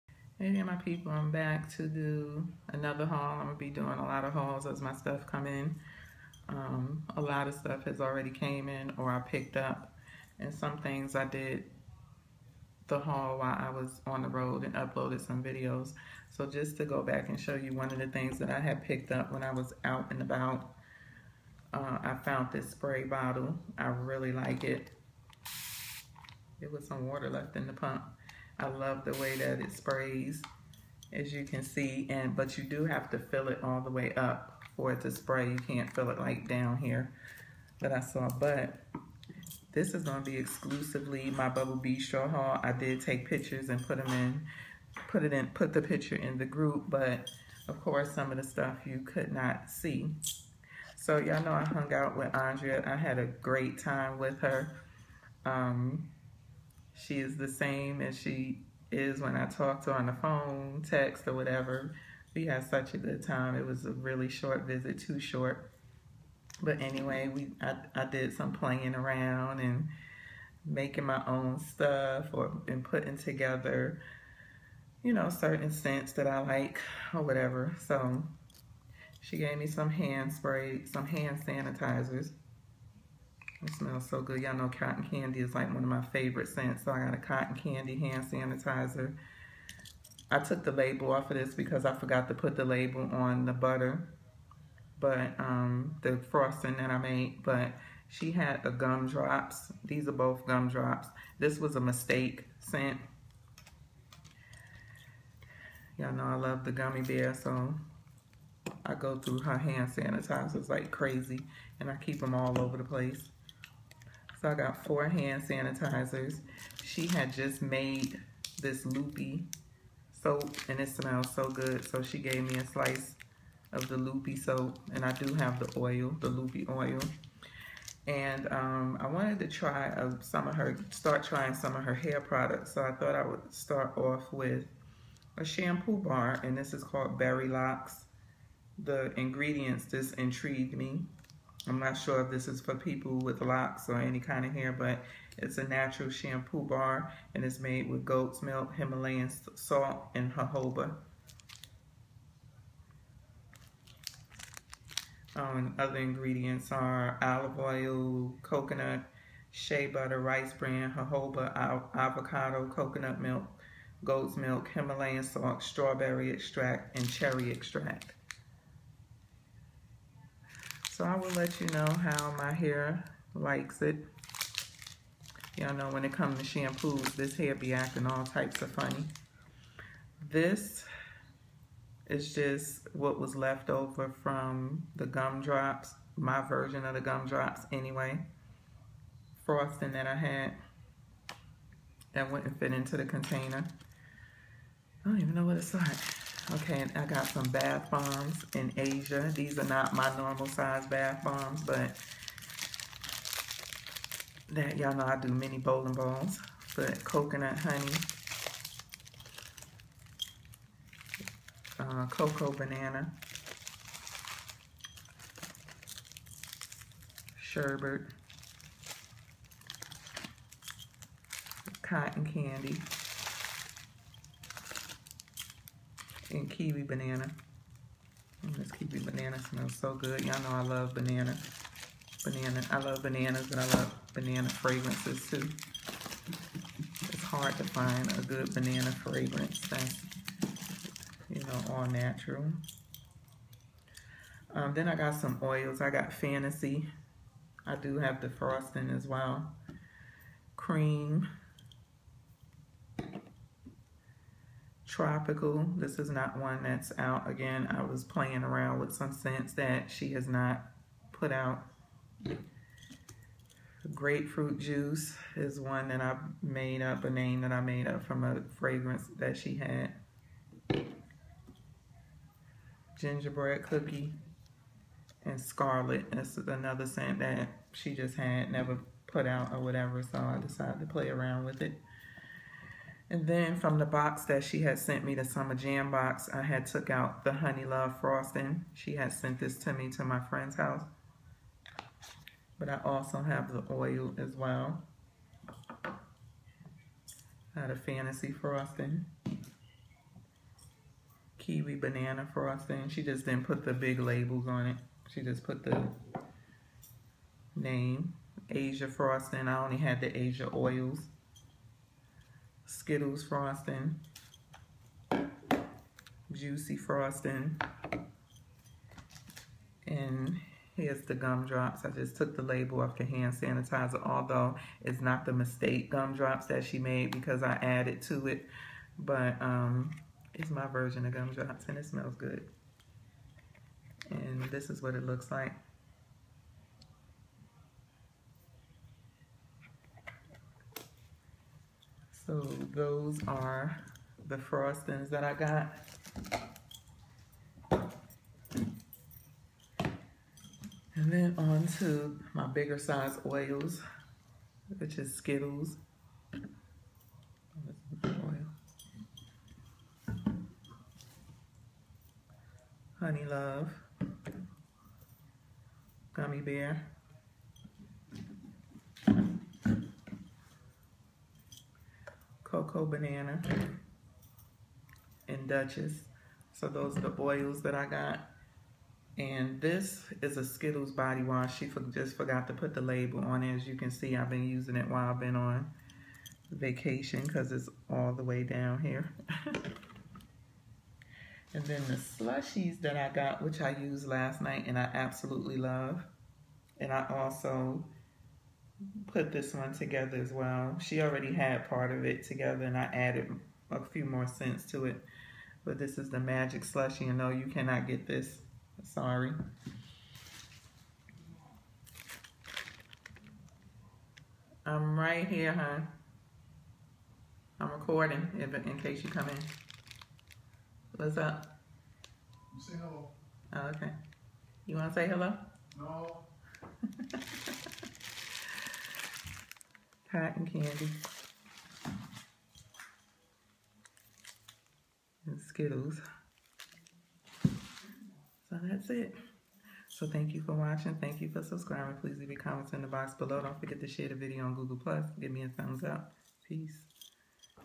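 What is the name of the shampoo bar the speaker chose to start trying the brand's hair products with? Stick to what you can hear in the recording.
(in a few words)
Berry Locks.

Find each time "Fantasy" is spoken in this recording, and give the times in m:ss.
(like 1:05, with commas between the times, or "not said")
4:06, 4:57.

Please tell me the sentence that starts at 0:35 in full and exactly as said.
You can't fill it like down here that I saw, but this is gonna be exclusively my Bubble Bistro haul.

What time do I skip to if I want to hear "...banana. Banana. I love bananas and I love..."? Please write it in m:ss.
3:50.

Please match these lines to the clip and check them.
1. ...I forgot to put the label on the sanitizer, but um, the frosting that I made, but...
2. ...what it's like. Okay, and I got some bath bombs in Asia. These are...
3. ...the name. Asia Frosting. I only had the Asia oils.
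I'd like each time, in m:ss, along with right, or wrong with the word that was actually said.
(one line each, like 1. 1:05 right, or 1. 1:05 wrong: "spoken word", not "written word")
1. 1:31 wrong: "butter", not "sanitizer"
2. 3:15 right
3. 5:05 right.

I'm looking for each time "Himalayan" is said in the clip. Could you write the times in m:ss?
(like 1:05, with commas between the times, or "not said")
2:28, 2:44.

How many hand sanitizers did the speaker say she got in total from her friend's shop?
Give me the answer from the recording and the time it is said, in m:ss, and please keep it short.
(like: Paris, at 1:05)
4, at 1:54.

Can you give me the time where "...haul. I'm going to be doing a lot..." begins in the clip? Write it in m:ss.
0:03.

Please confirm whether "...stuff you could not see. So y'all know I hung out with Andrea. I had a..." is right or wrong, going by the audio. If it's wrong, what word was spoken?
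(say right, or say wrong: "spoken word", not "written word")
right.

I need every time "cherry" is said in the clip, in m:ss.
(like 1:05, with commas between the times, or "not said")
2:47.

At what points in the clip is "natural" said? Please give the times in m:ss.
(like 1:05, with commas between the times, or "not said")
2:25, 4:01.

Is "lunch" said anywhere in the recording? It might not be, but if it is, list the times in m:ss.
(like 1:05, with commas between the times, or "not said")
not said.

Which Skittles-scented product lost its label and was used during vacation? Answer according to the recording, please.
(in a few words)
Body wash.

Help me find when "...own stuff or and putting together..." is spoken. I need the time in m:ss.
1:11.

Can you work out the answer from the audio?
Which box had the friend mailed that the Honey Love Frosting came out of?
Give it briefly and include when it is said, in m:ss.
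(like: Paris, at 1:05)
Summer Jam box, at 4:45.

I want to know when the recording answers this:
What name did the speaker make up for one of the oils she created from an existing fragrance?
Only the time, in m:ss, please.
4:23.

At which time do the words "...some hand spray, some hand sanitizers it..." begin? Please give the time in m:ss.
1:19.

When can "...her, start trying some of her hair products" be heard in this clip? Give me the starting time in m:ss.
2:10.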